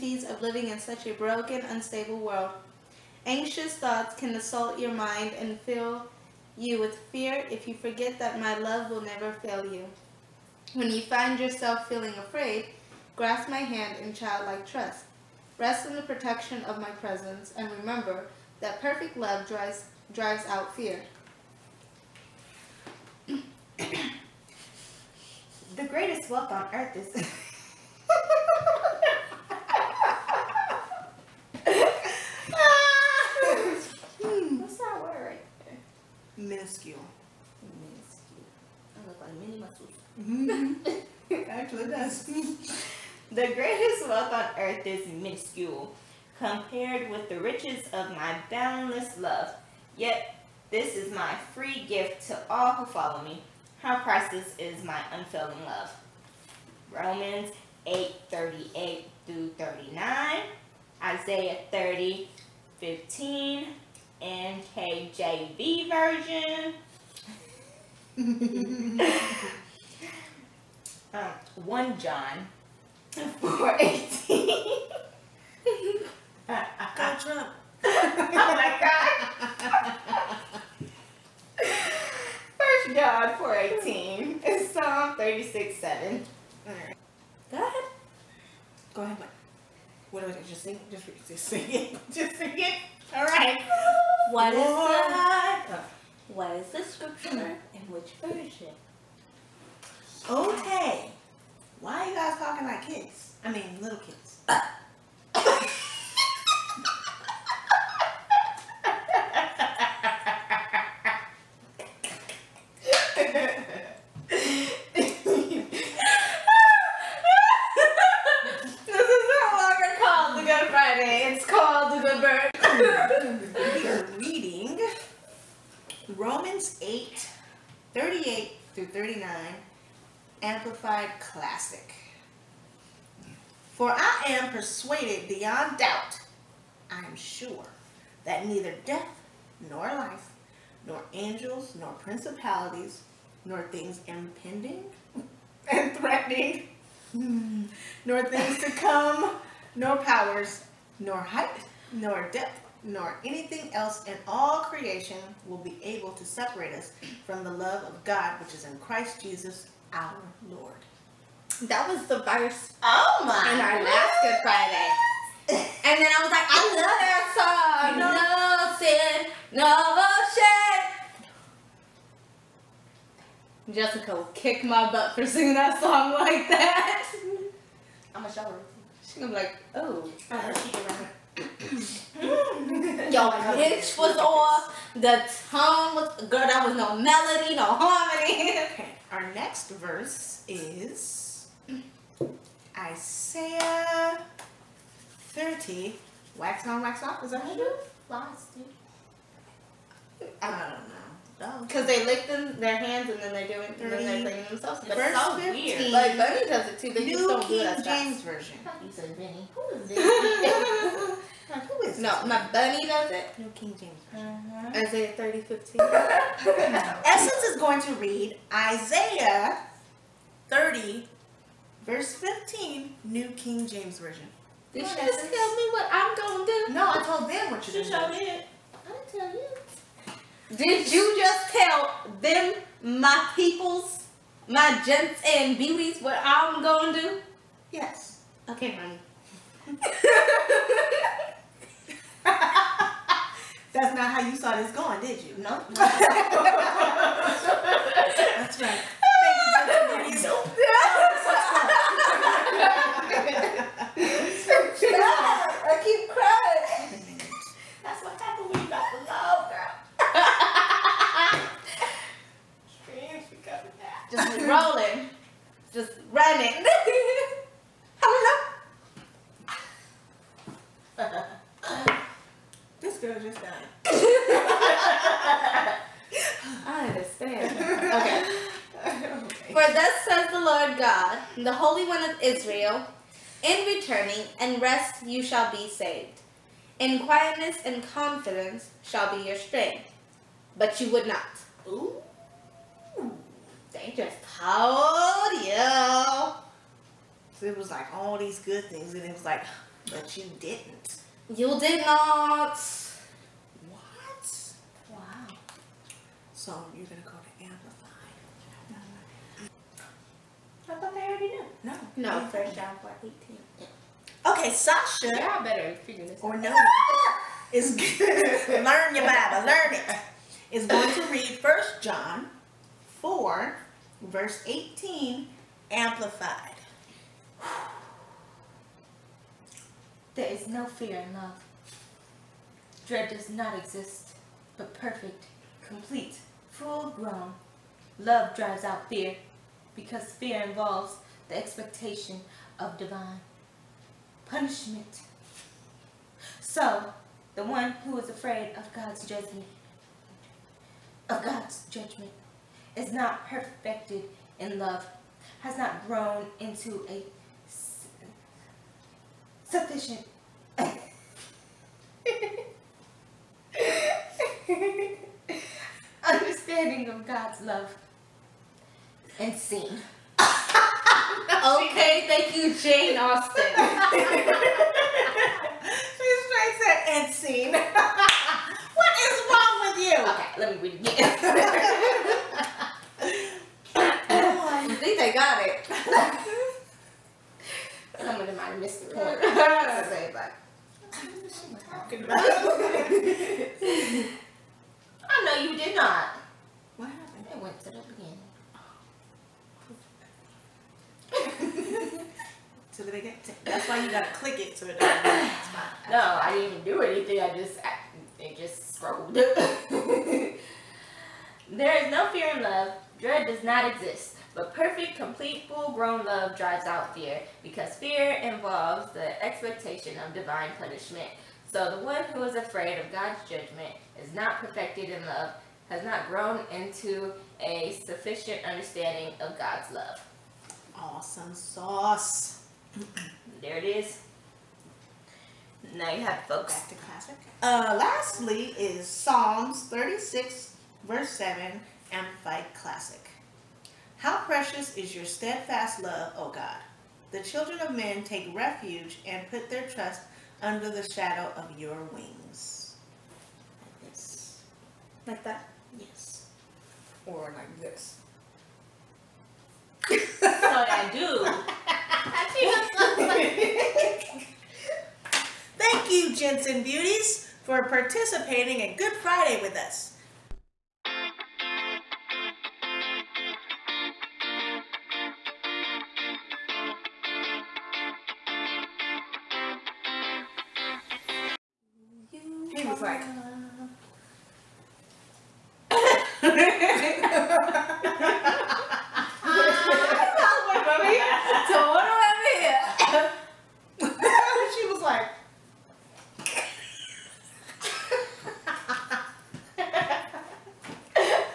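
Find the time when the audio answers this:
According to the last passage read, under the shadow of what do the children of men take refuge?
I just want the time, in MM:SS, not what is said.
07:31.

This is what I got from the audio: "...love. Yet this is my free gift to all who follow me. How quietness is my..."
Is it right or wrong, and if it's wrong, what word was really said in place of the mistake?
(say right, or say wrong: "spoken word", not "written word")
wrong: "priceless", not "quietness".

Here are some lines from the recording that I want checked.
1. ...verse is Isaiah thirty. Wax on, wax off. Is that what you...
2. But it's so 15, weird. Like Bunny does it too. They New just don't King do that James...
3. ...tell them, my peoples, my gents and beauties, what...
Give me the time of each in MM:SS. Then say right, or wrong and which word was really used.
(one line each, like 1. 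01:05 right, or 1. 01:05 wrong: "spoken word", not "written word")
1. 03:09 right
2. 03:24 right
3. 03:51 right.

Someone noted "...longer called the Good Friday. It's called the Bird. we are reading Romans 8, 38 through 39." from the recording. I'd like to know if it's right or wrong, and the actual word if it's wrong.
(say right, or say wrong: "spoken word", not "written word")
right.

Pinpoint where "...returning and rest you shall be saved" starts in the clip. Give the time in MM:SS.
04:43.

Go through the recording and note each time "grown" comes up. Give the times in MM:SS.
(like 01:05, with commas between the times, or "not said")
05:36, 05:55, 06:55, 07:06.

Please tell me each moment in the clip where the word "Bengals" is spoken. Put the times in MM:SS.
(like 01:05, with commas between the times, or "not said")
not said.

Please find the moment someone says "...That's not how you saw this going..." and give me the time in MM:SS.
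04:03.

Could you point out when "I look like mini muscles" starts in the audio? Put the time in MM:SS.
00:38.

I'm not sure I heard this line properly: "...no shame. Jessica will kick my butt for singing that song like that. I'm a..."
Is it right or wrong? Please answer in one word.
right.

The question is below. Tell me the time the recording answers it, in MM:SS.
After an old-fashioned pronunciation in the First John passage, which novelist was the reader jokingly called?
06:12.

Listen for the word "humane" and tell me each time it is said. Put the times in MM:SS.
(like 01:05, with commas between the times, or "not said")
not said.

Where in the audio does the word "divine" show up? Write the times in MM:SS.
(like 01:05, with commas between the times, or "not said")
05:42, 07:00.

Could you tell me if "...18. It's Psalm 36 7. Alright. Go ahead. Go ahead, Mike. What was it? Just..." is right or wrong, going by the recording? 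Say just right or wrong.
right.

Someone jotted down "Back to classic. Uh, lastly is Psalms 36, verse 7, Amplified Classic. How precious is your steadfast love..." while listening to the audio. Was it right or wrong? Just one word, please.
right.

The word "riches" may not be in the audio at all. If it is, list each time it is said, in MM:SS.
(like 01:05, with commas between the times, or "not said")
00:47.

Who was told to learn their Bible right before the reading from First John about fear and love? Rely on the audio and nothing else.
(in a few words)
Sasha.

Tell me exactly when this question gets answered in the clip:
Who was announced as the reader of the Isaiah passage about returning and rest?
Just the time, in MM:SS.
03:37.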